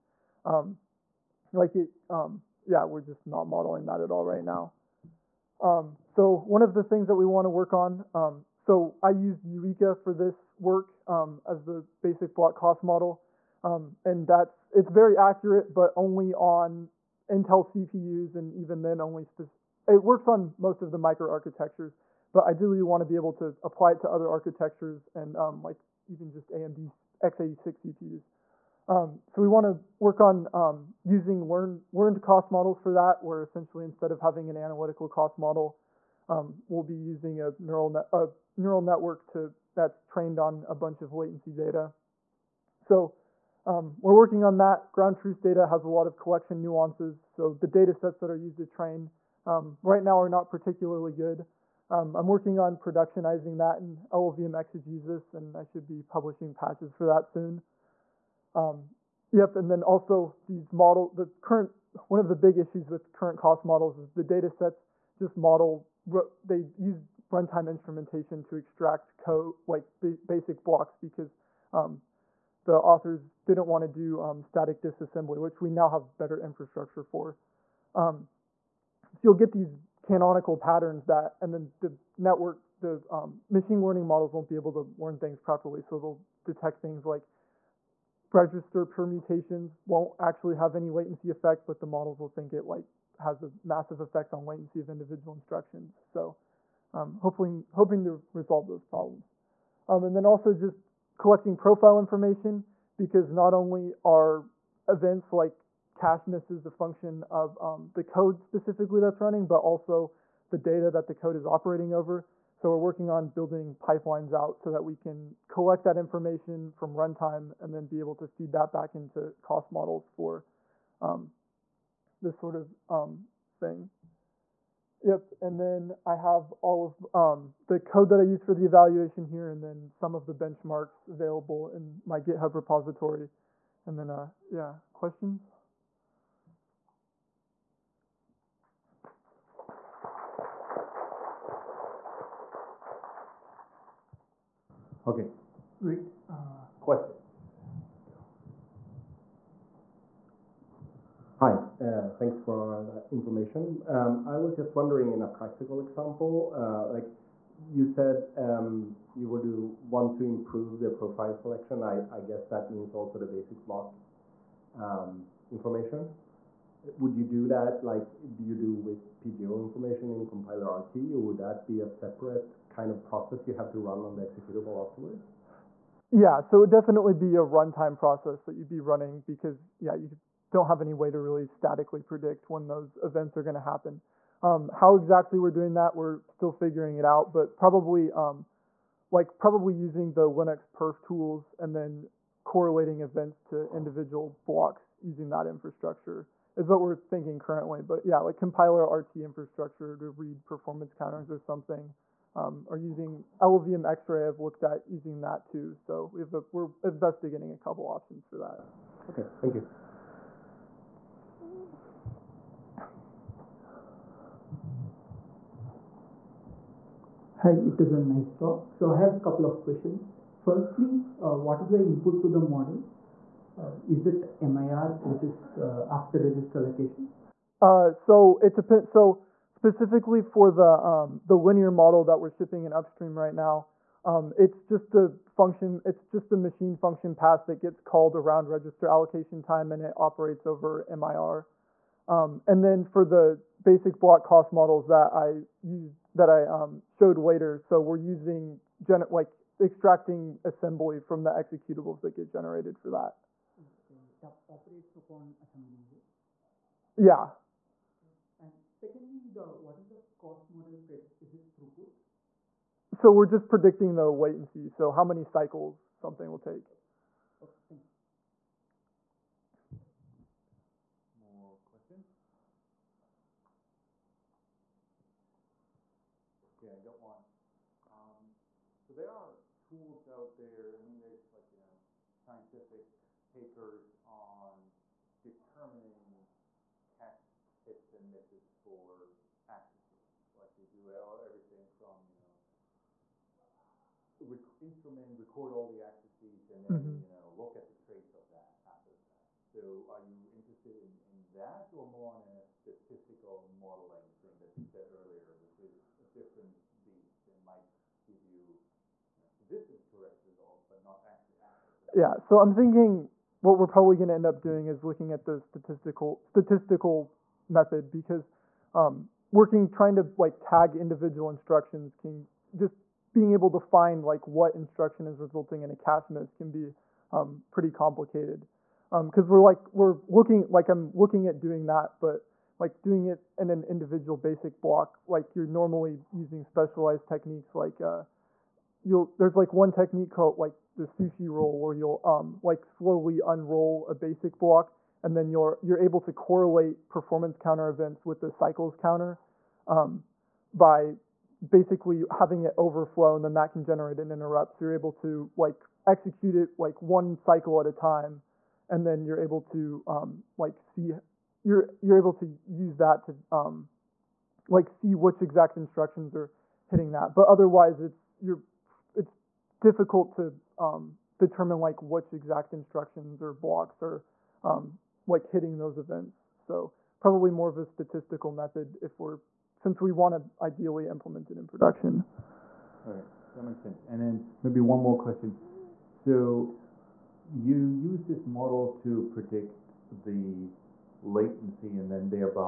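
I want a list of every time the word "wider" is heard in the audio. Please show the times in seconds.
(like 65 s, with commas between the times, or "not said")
not said.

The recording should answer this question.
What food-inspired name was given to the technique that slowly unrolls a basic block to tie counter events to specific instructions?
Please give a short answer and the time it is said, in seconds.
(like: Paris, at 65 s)
sushi roll, at 340 s.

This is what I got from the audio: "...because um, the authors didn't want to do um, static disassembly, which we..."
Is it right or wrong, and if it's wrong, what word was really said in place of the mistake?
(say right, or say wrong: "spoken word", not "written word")
right.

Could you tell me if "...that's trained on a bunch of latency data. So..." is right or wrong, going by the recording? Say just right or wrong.
right.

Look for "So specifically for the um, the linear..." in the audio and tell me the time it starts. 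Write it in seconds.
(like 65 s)
228 s.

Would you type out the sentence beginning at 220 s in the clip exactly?
Firstly, uh, what is the input to the model?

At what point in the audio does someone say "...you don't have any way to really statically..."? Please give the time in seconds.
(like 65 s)
179 s.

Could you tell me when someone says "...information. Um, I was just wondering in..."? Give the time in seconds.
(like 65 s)
153 s.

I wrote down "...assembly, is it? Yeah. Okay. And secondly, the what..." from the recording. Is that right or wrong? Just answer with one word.
right.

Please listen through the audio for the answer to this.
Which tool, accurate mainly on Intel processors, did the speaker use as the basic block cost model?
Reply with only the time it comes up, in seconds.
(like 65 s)
9 s.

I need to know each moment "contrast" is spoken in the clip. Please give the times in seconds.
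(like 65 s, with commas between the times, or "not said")
not said.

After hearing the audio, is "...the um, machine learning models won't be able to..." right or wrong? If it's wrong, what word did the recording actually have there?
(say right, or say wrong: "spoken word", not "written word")
right.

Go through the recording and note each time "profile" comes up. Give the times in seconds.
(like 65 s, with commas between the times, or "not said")
101 s, 160 s.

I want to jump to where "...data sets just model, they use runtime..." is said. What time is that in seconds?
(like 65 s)
64 s.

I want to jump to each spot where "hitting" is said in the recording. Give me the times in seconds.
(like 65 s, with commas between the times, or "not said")
366 s, 375 s.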